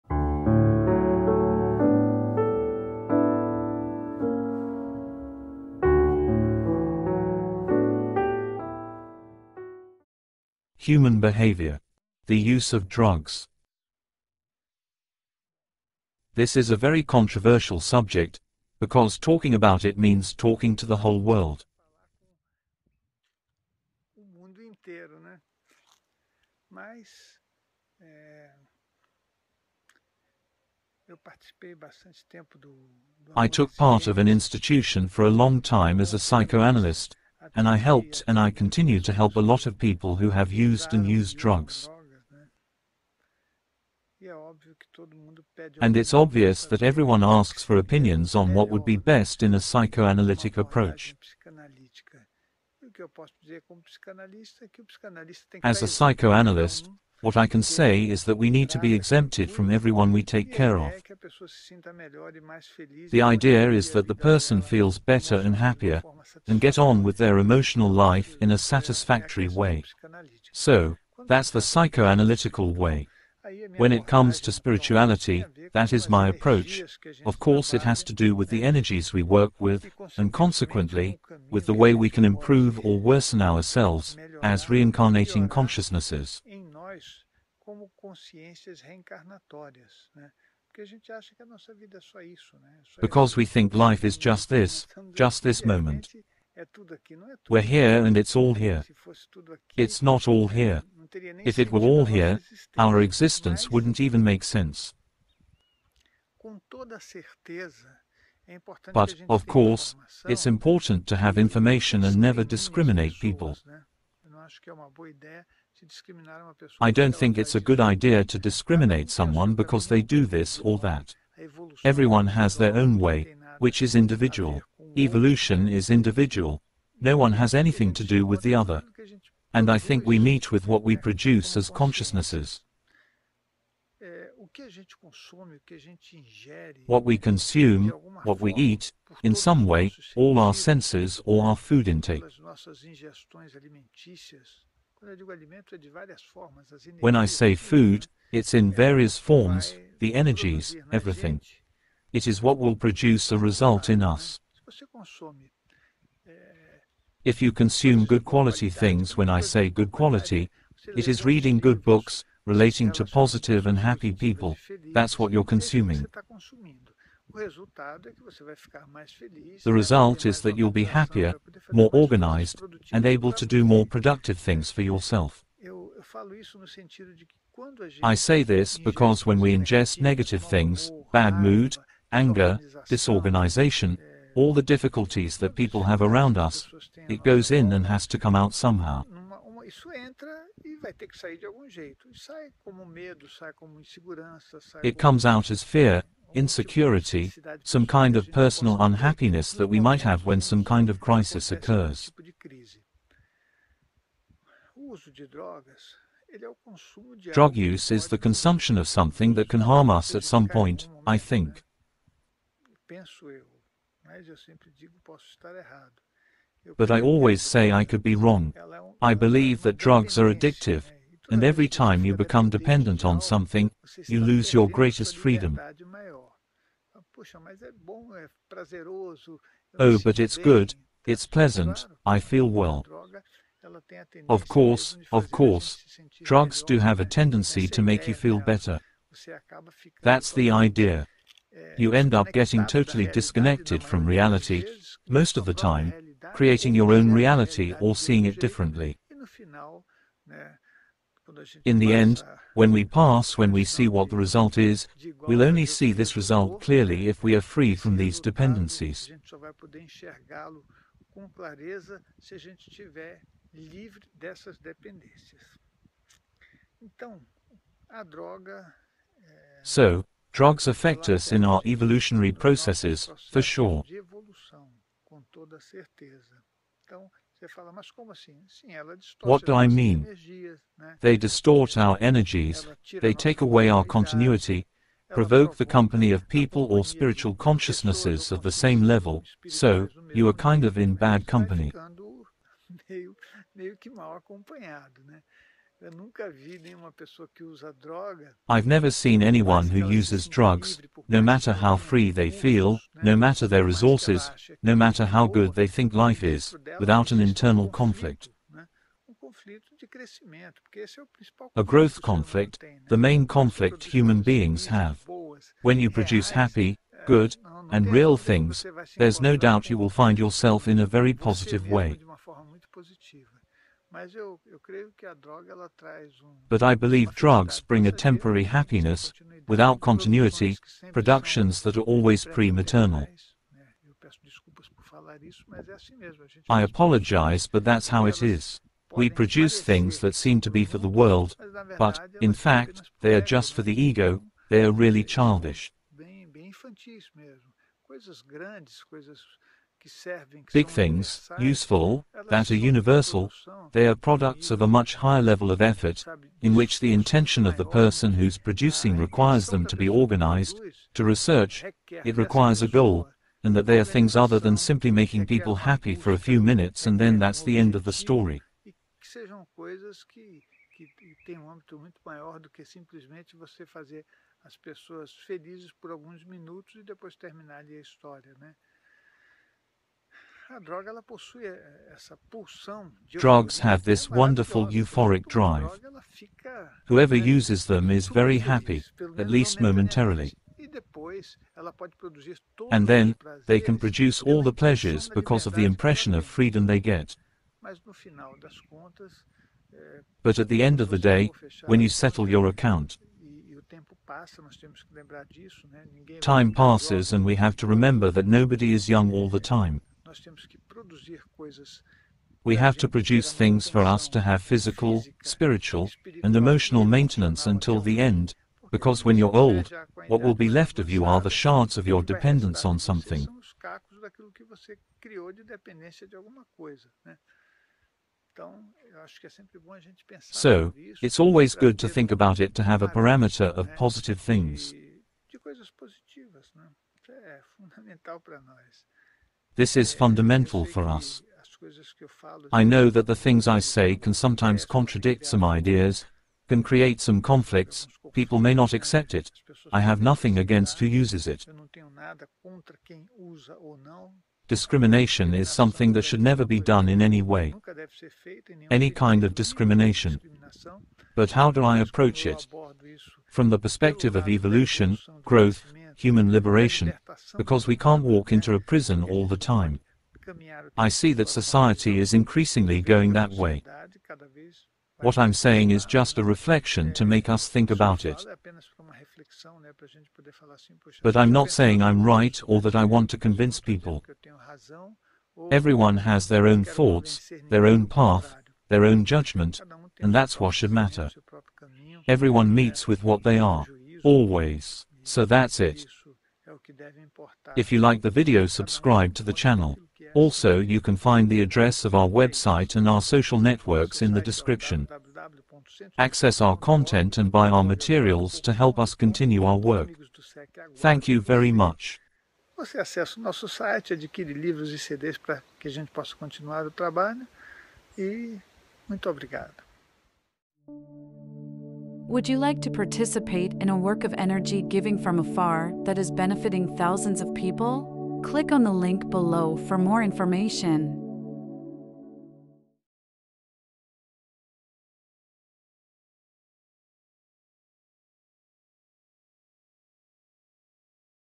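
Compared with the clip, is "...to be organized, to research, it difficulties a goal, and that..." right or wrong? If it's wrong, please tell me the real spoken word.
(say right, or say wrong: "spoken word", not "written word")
wrong: "requires", not "difficulties".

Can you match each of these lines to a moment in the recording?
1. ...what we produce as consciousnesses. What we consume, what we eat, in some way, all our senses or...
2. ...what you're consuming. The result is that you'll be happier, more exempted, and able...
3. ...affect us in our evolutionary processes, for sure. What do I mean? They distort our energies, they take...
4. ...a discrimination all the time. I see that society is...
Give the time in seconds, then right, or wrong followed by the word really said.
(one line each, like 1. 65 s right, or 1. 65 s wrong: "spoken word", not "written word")
1. 130 s right
2. 165 s wrong: "organized", not "exempted"
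3. 270 s right
4. 468 s wrong: "prison", not "discrimination".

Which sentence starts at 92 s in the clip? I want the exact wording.
Because we think life is just this, just this moment.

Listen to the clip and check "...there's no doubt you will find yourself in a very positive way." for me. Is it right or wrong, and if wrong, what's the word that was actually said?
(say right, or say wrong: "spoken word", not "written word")
right.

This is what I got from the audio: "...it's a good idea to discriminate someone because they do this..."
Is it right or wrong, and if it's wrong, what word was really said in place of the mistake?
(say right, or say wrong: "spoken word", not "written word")
right.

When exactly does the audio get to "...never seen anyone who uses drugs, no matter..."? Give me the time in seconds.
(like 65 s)
298 s.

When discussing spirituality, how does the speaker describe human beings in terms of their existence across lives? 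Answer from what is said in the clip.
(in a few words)
reincarnating consciousnesses.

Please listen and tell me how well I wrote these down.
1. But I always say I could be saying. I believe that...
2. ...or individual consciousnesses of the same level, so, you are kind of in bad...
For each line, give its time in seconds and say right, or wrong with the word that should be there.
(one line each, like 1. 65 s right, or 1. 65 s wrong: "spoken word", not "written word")
1. 216 s wrong: "wrong", not "saying"
2. 286 s wrong: "spiritual", not "individual".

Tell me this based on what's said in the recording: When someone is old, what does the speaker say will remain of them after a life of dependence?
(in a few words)
shards.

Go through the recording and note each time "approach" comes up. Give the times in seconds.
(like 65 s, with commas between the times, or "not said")
50 s, 76 s, 461 s.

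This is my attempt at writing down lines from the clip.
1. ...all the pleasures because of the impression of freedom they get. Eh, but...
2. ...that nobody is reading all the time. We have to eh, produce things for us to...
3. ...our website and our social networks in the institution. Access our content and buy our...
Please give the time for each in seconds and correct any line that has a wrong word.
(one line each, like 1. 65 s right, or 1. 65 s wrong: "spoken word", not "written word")
1. 394 s right
2. 408 s wrong: "young", not "reading"
3. 501 s wrong: "description", not "institution".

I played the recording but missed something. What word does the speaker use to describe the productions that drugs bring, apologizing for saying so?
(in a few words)
pre-maternal.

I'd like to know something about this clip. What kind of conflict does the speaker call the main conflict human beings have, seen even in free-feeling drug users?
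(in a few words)
growth conflict.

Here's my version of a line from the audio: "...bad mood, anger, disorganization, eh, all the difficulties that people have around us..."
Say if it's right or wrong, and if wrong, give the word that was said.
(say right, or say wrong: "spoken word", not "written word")
right.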